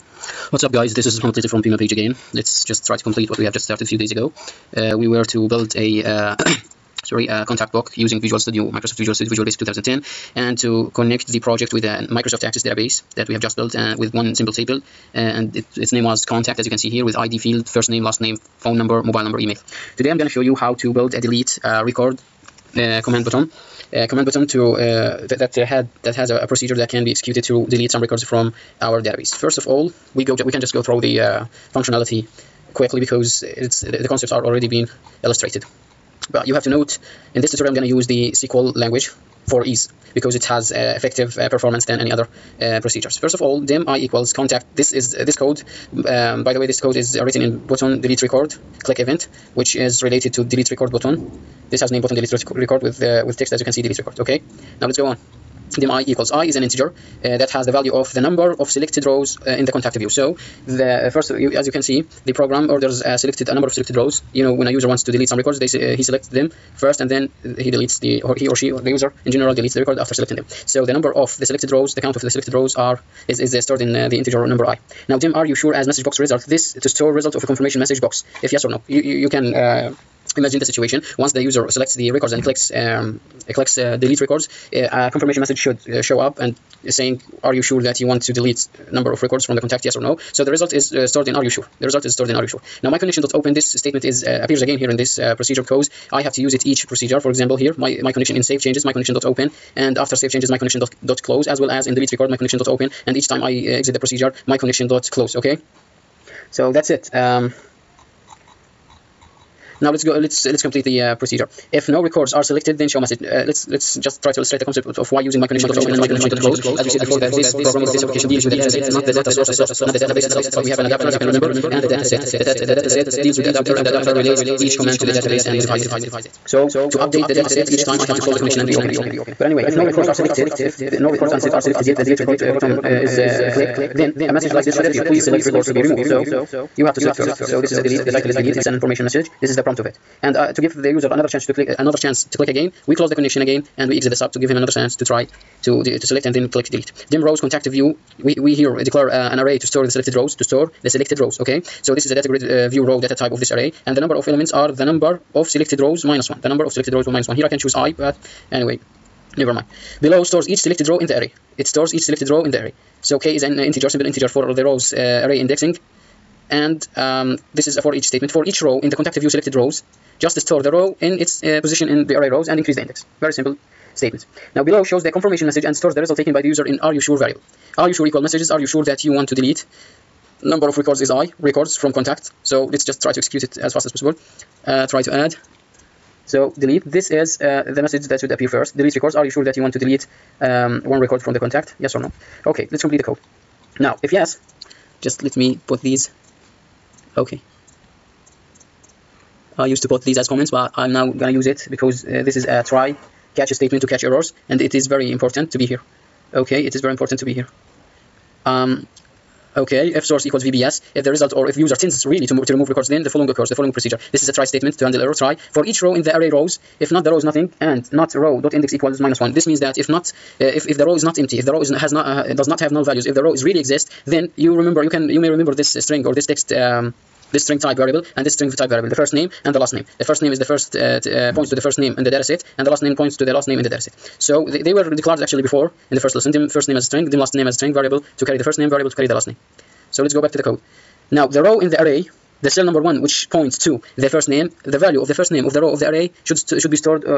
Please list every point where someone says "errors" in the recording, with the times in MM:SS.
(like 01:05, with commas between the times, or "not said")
03:24, 03:35.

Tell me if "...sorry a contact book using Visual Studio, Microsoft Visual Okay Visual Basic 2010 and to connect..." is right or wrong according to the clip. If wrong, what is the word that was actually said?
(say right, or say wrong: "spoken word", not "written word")
wrong: "Studio", not "Okay".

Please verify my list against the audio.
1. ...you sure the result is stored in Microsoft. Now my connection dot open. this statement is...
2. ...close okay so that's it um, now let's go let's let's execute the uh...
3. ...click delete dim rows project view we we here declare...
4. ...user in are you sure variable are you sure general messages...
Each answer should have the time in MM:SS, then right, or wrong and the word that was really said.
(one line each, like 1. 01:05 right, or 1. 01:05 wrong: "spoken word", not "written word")
1. 01:31 wrong: "RxShore", not "Microsoft"
2. 01:45 wrong: "complete", not "execute"
3. 02:26 wrong: "contact", not "project"
4. 02:56 wrong: "equal", not "general".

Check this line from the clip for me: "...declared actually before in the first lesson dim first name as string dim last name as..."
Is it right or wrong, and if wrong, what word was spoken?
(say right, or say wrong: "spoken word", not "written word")
right.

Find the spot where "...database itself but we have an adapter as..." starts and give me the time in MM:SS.
01:59.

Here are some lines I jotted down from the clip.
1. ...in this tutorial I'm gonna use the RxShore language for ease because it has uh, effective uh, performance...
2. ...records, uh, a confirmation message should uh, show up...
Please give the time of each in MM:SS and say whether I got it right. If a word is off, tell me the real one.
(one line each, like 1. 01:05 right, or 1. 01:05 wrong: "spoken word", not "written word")
1. 00:37 wrong: "SQL", not "RxShore"
2. 01:24 right.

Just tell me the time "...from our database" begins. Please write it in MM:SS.
00:28.